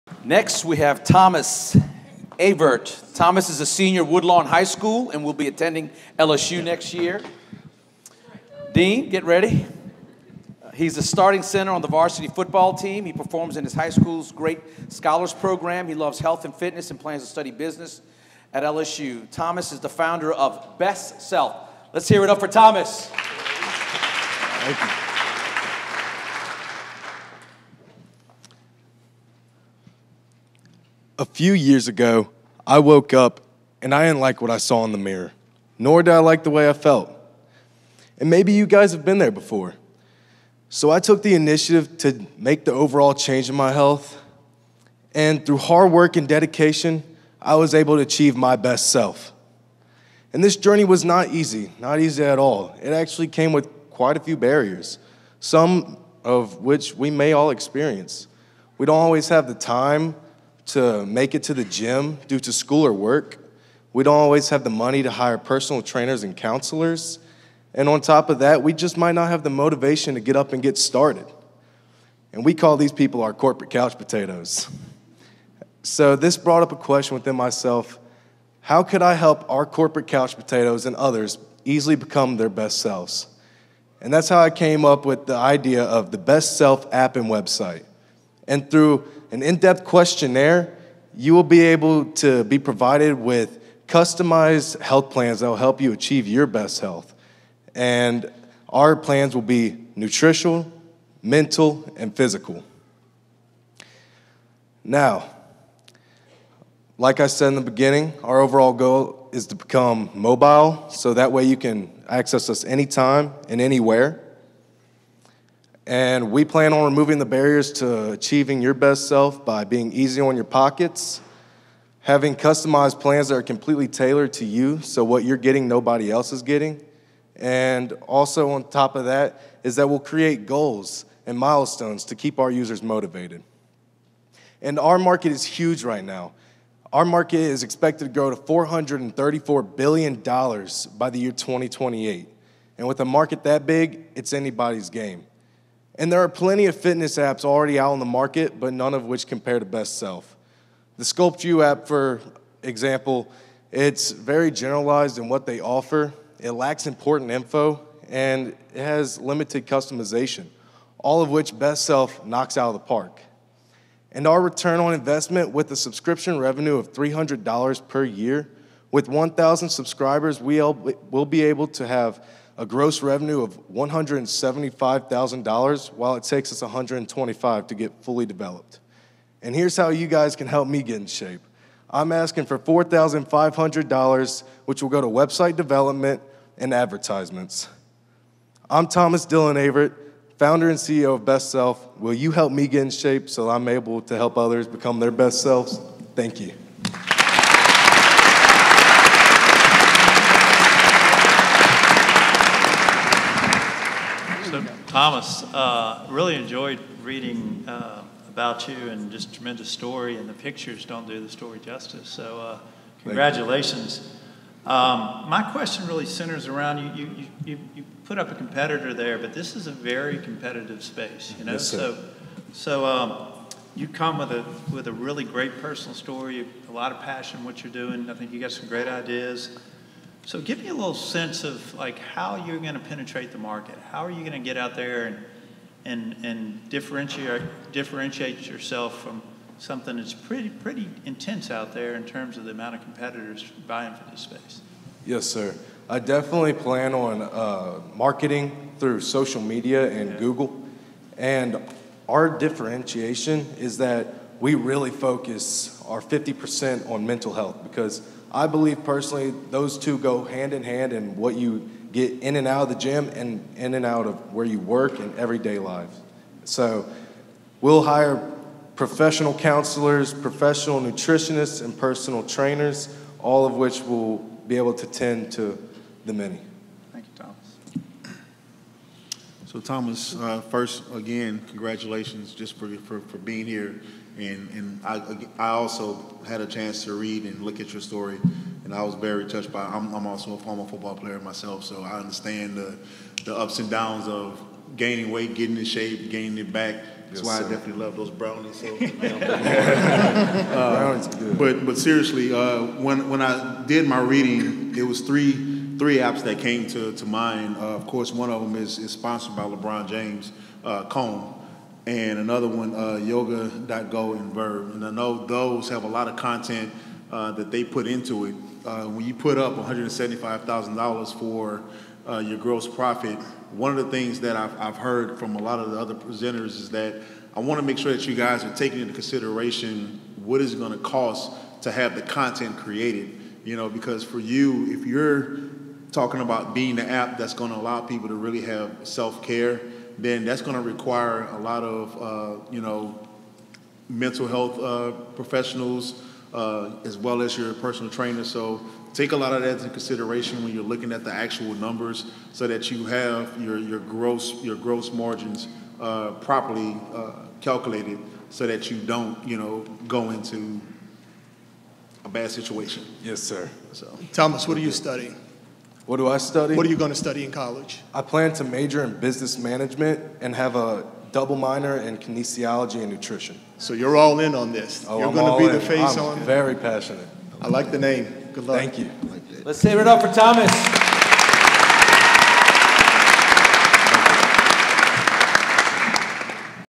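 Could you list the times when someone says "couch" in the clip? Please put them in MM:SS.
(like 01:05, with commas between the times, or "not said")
01:13, 01:20.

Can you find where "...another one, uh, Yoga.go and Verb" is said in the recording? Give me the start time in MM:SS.
05:12.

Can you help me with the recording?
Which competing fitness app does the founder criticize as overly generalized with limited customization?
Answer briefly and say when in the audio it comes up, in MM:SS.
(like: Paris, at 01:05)
Sculpt You, at 02:31.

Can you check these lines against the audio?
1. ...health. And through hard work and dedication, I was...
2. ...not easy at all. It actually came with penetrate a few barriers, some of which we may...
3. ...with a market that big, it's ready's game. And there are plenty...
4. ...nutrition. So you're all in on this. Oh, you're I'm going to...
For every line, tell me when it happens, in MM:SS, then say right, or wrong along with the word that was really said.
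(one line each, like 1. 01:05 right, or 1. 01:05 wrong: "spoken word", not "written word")
1. 00:43 right
2. 00:51 wrong: "quite", not "penetrate"
3. 02:22 wrong: "anybody", not "ready"
4. 06:12 right.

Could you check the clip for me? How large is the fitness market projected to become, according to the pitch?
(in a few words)
$434 billion.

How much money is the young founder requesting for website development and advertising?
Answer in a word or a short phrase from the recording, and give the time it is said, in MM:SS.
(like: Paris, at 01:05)
$4,500, at 03:02.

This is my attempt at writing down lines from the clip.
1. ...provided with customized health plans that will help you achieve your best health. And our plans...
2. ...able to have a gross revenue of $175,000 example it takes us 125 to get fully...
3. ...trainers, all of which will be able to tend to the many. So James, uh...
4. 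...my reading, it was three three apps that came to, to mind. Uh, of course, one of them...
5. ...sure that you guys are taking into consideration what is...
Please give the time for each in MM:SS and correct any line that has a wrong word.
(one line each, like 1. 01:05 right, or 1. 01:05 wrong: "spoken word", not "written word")
1. 01:32 right
2. 02:51 wrong: "while", not "example"
3. 04:32 wrong: "Thomas", not "James"
4. 05:03 right
5. 05:27 right.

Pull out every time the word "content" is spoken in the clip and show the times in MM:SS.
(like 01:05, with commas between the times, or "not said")
05:16, 05:32.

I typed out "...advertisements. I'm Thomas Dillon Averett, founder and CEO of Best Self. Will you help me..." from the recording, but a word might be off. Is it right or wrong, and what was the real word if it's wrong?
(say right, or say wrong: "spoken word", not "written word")
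right.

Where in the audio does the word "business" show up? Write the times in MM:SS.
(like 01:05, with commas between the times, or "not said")
00:17, 06:09.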